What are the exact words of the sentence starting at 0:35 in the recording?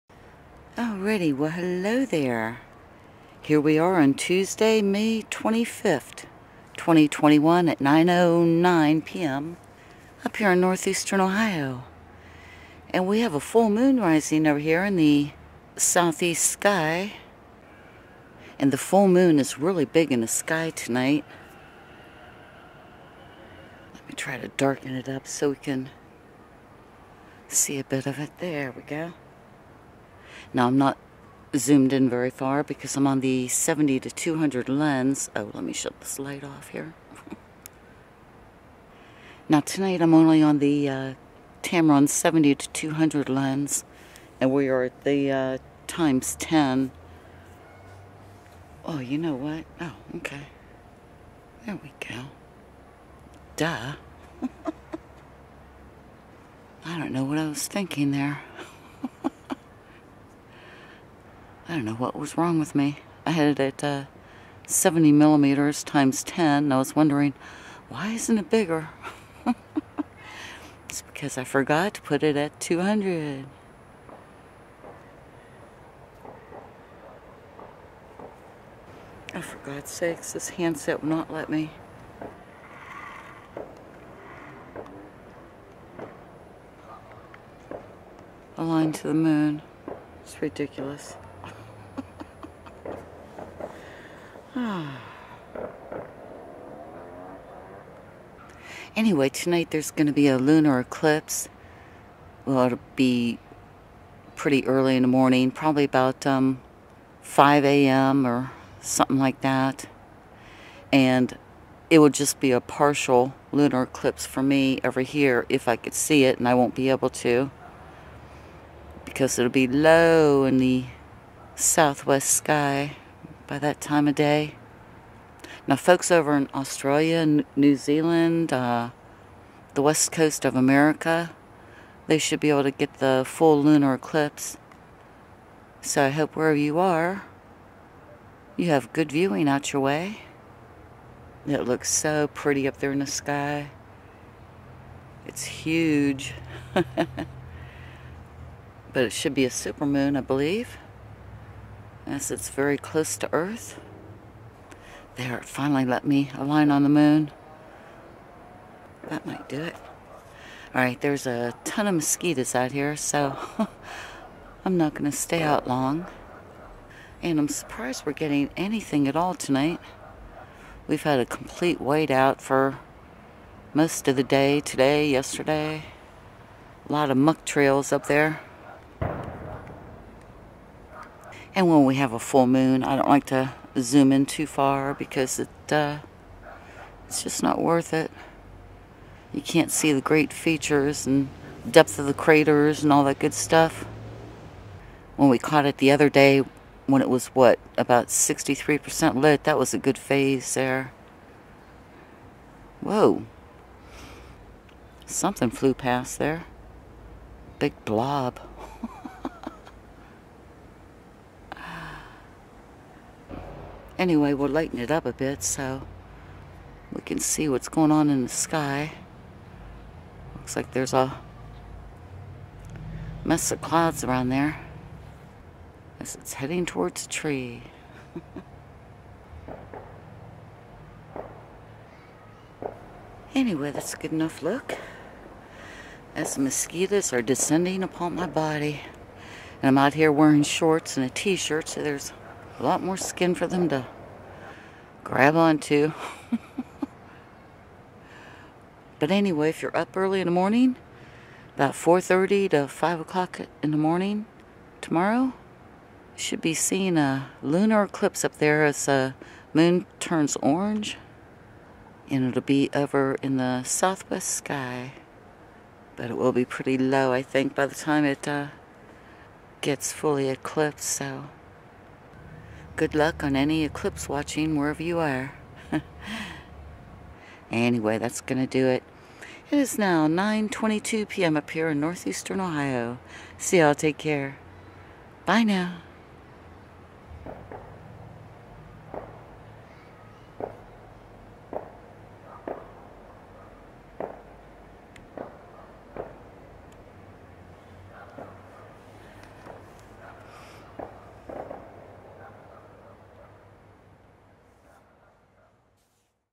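Oh, let me shut this light off here.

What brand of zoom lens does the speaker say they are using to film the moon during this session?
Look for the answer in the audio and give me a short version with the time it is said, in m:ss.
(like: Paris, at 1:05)
Tamron, at 0:41.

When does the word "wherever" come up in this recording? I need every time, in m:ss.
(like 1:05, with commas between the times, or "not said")
2:16, 4:34.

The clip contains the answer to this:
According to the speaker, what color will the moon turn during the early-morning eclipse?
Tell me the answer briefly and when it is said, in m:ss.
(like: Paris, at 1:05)
Orange, at 4:20.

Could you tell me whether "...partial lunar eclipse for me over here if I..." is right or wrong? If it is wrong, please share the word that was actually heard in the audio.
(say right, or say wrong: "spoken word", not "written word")
right.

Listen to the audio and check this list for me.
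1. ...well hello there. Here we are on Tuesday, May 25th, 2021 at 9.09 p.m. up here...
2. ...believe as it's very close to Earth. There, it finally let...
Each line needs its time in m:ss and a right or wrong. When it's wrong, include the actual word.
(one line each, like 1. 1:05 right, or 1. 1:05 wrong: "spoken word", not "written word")
1. 0:01 right
2. 2:30 right.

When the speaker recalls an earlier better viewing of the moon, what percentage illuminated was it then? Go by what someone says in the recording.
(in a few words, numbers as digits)
63%.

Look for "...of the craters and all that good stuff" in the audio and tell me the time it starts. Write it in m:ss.
3:11.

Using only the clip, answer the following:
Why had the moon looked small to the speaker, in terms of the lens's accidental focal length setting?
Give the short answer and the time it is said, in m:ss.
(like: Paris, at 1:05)
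70 millimeters, at 1:04.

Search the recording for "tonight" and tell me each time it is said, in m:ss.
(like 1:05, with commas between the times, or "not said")
0:20, 0:39, 1:39, 2:49.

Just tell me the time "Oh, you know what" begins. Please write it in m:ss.
0:48.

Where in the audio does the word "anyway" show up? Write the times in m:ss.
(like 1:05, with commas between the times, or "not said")
1:38, 3:34, 3:53, 4:09, 4:37.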